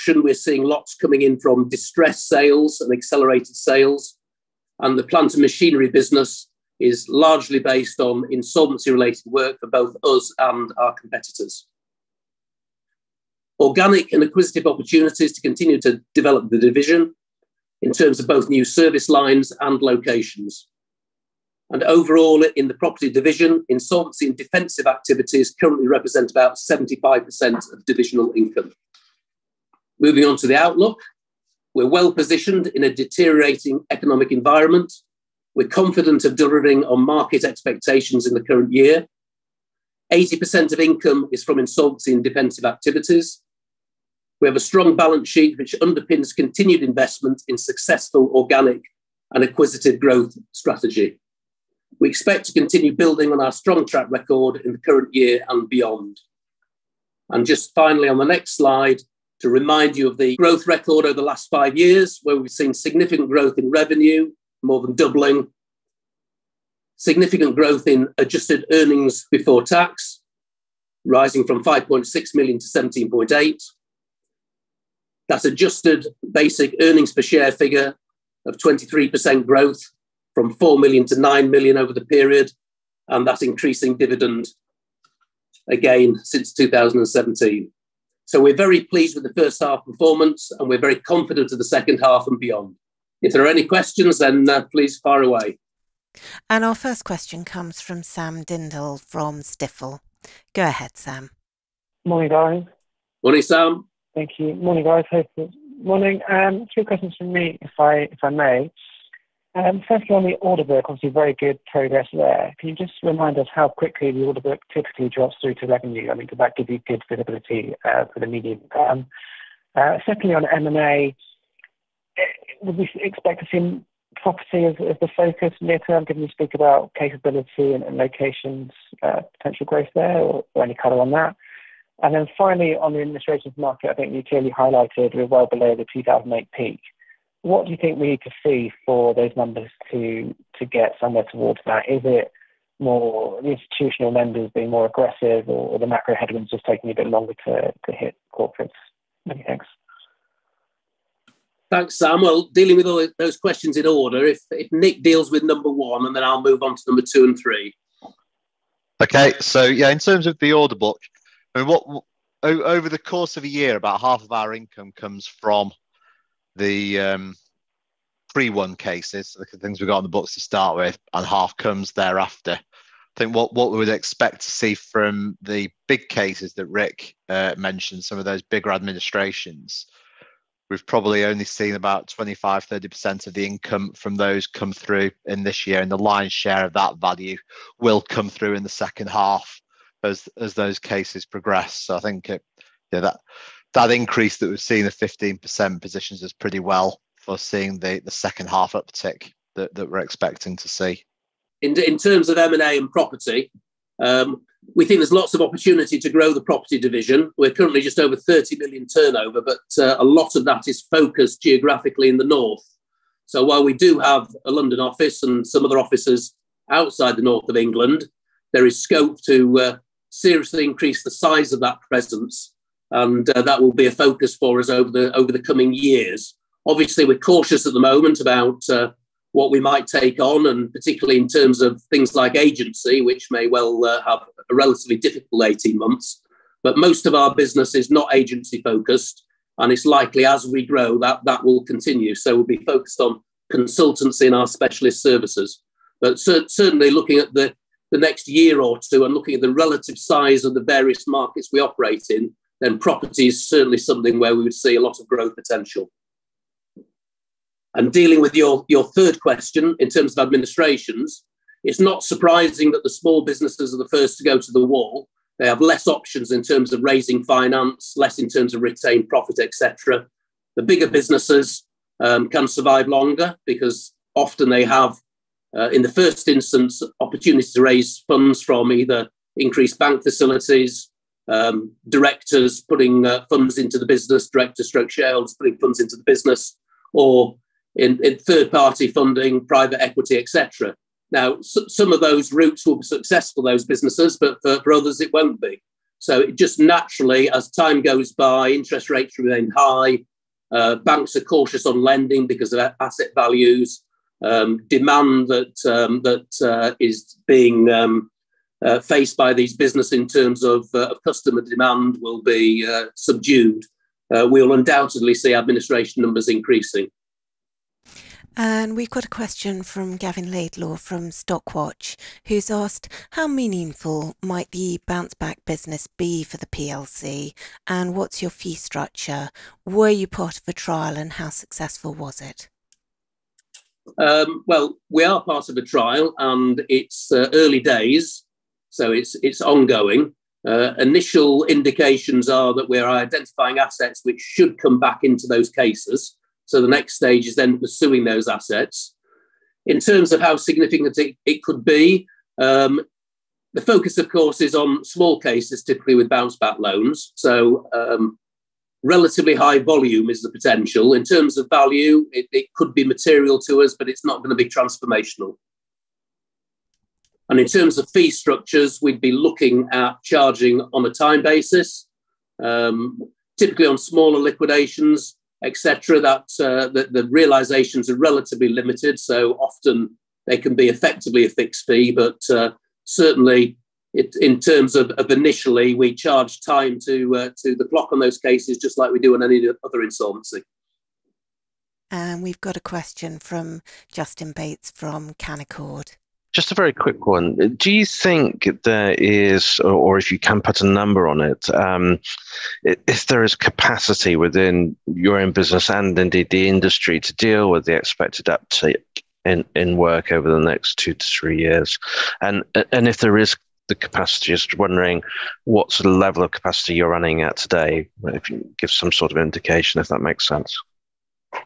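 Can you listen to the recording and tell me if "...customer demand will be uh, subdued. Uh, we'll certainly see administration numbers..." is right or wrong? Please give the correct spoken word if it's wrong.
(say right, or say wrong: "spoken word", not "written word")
wrong: "undoubtedly", not "certainly".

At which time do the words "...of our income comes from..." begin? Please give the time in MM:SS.
02:44.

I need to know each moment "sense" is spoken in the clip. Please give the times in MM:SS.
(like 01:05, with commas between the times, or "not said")
07:00.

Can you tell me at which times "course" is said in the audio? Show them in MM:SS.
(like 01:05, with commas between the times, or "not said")
02:42, 05:54.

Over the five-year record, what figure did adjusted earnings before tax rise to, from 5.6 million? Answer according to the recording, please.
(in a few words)
17.8 million.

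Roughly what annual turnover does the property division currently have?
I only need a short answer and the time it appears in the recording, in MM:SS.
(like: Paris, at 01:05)
just over 30 million, at 03:27.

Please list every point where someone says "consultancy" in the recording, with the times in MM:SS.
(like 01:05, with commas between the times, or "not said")
04:03.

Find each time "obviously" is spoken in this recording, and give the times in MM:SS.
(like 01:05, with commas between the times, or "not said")
01:50, 03:46.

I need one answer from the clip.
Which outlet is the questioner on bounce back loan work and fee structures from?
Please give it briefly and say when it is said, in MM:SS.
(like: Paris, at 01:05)
Stockwatch, at 05:21.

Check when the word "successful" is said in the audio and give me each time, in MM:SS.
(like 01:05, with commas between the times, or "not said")
00:47, 04:52, 05:31.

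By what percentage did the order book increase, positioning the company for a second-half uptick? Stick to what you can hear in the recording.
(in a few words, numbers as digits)
15%.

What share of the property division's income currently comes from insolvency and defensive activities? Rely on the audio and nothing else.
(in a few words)
75%.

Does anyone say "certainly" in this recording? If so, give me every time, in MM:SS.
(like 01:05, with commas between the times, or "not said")
04:06, 04:13, 06:22.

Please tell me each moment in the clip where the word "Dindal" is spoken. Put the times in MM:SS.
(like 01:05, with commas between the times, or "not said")
01:38.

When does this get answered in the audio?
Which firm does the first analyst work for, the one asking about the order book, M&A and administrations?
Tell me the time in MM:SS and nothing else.
01:39.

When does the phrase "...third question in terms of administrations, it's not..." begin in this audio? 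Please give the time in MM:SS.
04:18.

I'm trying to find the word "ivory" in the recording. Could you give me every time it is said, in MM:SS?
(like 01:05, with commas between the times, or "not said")
not said.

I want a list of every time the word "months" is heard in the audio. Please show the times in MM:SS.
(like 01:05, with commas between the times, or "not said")
03:55.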